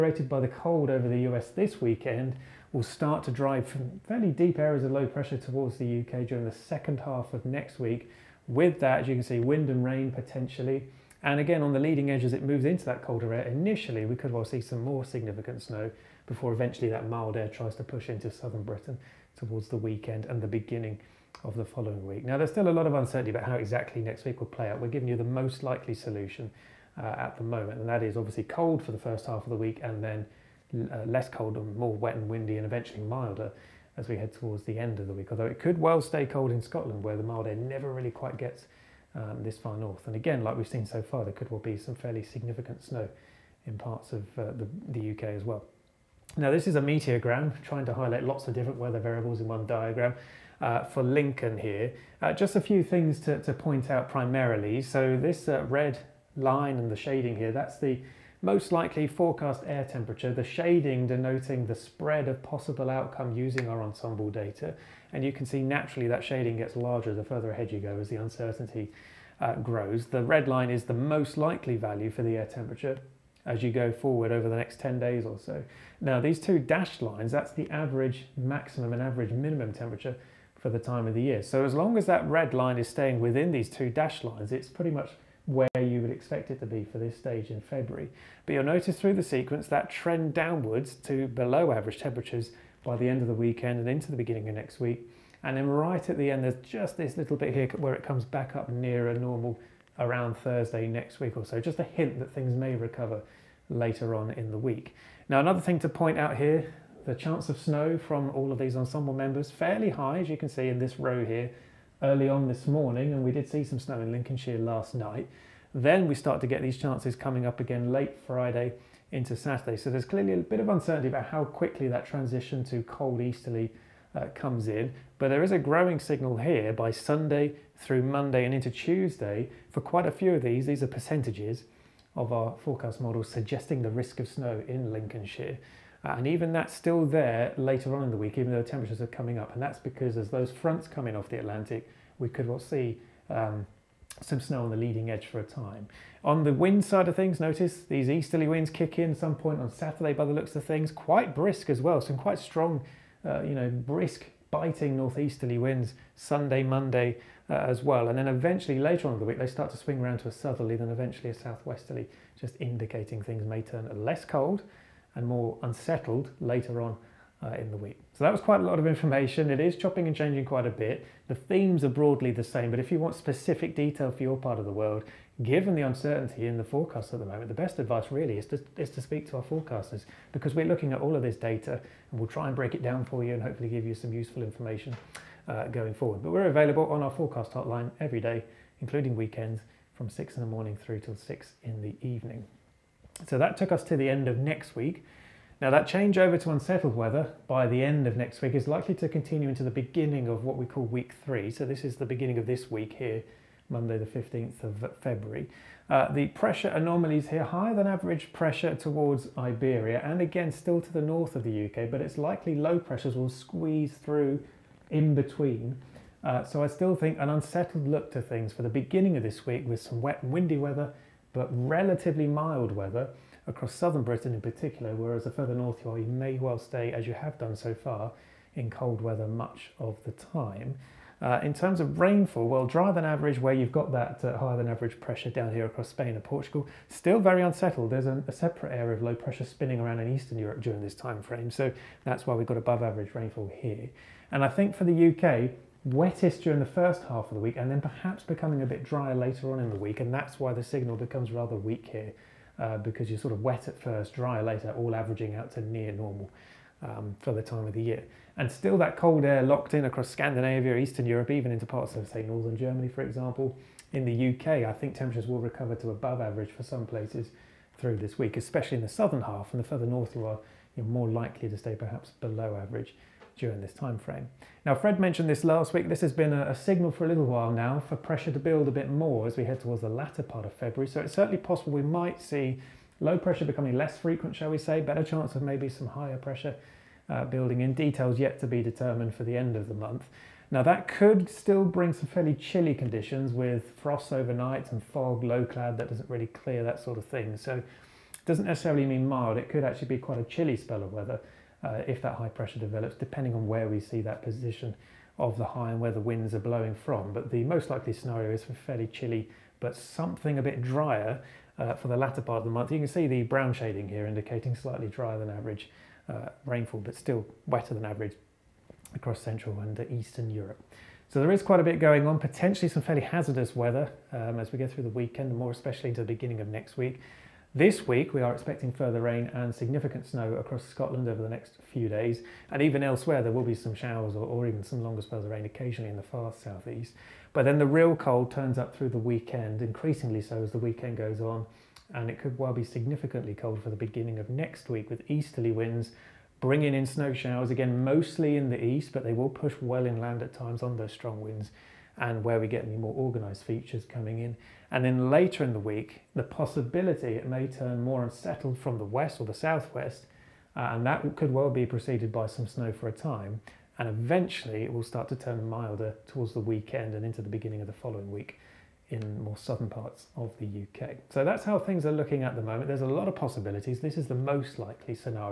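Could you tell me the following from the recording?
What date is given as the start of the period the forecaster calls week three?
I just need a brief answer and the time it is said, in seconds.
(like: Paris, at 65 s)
Monday 15 February, at 203 s.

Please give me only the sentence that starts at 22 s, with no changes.
Now, there's still a lot of uncertainty about how exactly next week will play out.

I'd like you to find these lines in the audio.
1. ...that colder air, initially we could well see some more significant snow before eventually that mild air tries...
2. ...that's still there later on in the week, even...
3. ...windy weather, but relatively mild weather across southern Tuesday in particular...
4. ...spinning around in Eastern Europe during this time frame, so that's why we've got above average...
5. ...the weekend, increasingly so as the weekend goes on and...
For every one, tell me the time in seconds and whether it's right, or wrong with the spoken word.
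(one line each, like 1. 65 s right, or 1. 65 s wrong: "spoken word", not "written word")
1. 12 s right
2. 136 s right
3. 220 s wrong: "Britain", not "Tuesday"
4. 239 s right
5. 338 s right.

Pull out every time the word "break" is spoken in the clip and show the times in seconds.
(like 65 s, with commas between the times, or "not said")
182 s.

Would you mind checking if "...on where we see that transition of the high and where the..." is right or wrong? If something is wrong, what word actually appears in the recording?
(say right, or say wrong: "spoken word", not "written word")
wrong: "position", not "transition".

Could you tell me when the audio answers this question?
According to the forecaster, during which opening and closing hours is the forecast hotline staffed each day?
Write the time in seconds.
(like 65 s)
190 s.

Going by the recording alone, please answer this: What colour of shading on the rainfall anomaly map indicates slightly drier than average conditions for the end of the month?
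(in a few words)
Brown.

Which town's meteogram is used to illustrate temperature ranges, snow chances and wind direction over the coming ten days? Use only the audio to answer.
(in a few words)
Lincoln.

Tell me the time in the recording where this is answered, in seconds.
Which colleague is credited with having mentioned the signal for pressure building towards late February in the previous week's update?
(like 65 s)
274 s.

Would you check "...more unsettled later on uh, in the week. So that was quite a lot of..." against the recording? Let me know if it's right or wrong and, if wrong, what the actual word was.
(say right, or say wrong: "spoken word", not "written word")
right.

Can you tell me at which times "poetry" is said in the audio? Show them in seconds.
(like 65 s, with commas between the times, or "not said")
not said.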